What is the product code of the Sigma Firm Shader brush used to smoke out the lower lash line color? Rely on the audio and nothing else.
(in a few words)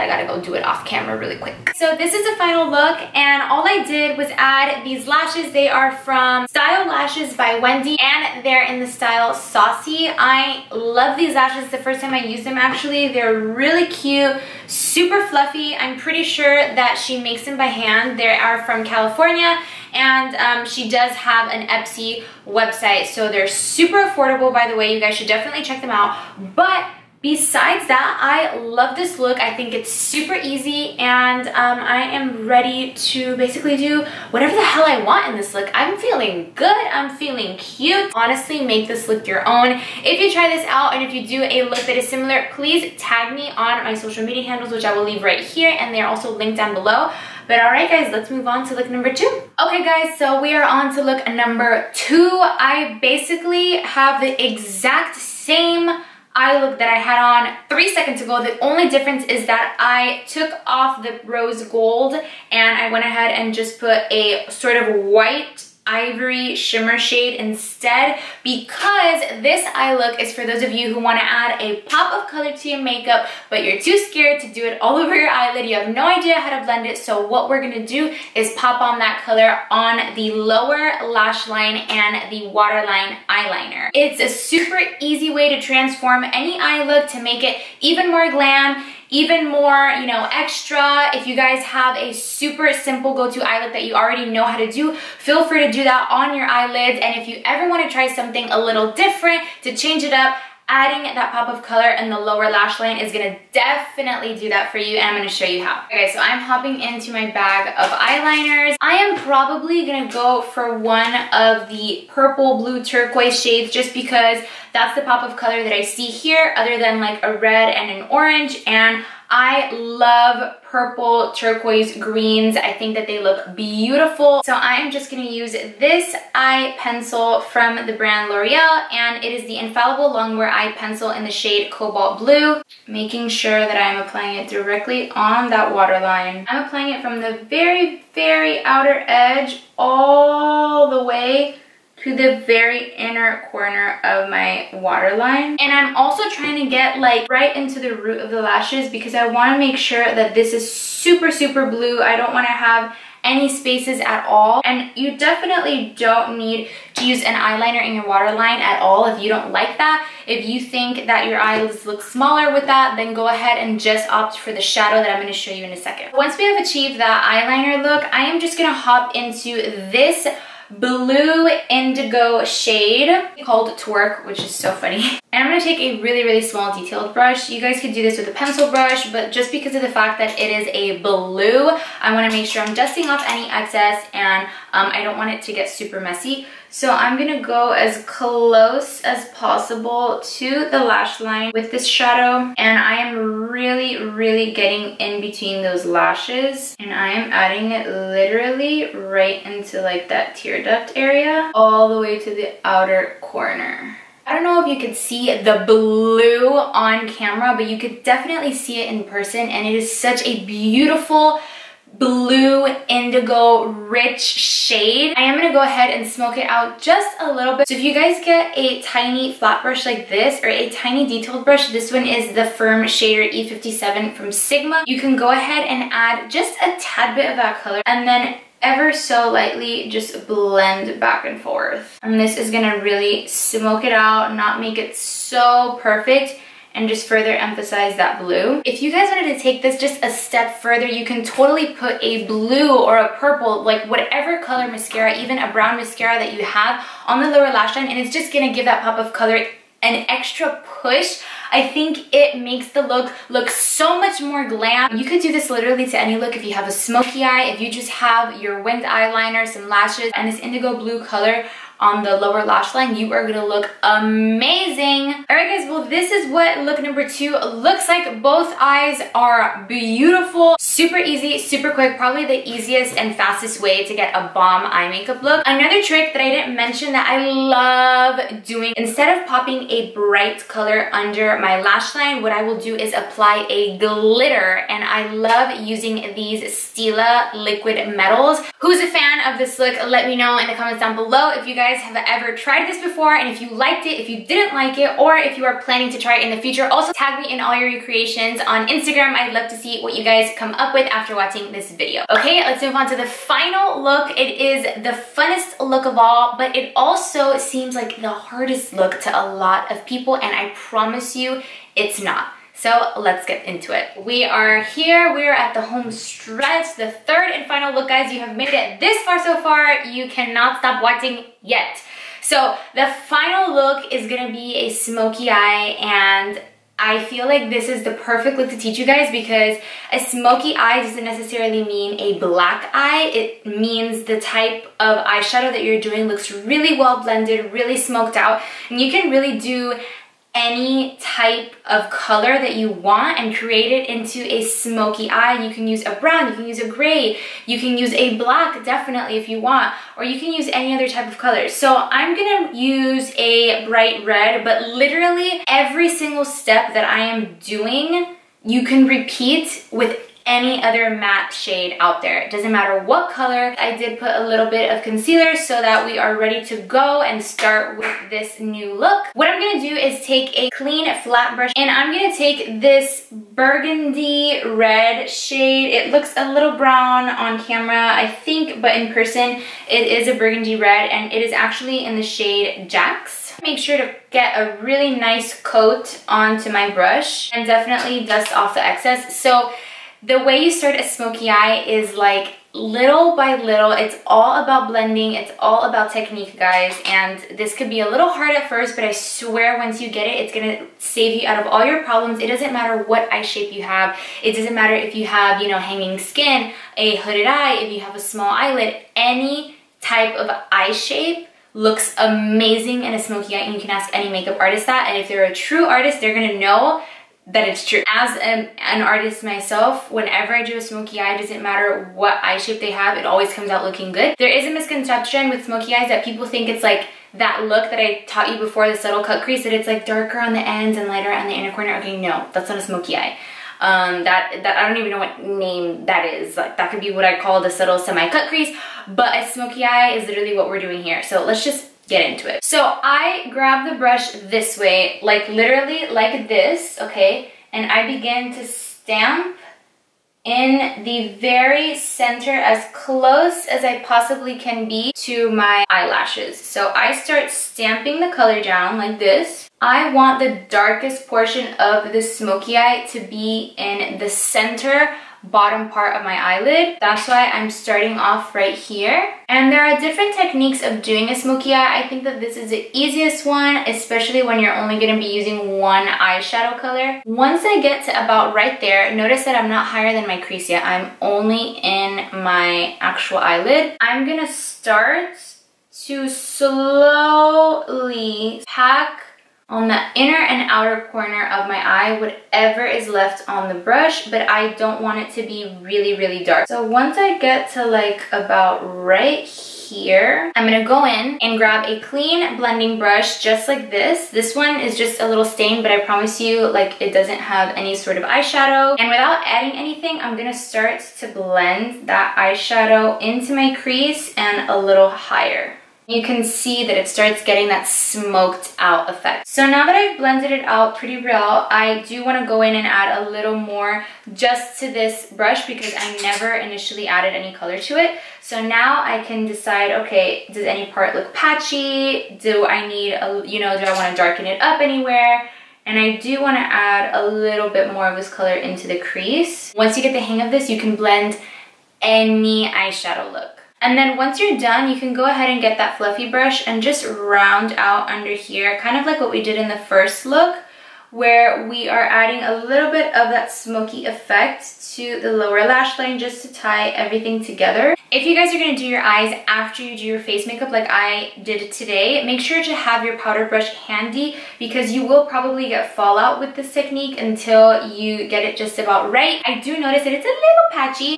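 E57.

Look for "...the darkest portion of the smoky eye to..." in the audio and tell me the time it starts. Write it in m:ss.
7:40.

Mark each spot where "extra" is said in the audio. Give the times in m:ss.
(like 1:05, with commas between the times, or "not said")
1:30, 4:10.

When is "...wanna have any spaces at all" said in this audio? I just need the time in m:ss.
2:32.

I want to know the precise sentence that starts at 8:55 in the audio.
And I do want to add a little bit more of this color into the crease.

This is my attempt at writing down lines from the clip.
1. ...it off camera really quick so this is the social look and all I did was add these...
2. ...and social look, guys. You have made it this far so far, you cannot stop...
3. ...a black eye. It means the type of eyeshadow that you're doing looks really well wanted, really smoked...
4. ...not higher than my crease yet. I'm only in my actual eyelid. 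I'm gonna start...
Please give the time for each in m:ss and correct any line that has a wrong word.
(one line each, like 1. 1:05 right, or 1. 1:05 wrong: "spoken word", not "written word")
1. 0:00 wrong: "final", not "social"
2. 5:17 wrong: "final", not "social"
3. 5:32 wrong: "blended", not "wanted"
4. 7:59 right.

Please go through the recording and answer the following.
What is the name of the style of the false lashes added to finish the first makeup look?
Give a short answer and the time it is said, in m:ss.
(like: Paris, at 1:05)
Saucy, at 0:09.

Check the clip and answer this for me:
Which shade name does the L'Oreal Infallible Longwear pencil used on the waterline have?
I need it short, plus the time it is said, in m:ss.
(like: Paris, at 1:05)
Cobalt Blue, at 2:11.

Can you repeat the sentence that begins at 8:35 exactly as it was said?
You can see that it starts getting that smoked out effect.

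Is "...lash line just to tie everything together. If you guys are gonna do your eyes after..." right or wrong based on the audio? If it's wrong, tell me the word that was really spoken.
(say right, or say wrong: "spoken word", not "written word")
right.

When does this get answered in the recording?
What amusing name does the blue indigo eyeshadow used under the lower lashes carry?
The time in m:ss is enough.
2:53.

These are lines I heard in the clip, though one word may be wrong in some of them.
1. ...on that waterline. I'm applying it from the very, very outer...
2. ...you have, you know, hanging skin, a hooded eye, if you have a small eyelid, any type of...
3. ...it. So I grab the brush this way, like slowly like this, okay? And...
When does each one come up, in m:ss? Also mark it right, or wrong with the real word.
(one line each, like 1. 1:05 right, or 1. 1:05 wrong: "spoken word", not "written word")
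1. 2:15 right
2. 6:44 right
3. 7:22 wrong: "literally", not "slowly".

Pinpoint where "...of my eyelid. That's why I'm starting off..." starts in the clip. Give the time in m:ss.
7:45.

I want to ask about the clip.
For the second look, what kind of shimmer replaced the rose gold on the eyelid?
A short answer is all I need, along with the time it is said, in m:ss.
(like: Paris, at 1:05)
white ivory shimmer, at 1:05.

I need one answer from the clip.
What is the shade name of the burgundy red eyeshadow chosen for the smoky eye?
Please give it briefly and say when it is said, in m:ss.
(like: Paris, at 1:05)
Jax, at 6:22.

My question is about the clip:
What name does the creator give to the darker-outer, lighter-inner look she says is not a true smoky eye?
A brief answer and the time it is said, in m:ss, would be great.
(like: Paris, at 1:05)
subtle semi-cut crease, at 7:17.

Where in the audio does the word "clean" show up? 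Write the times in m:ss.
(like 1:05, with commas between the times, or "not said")
6:10, 8:21.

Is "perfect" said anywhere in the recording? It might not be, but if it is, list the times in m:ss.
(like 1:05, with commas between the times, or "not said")
3:55, 5:27.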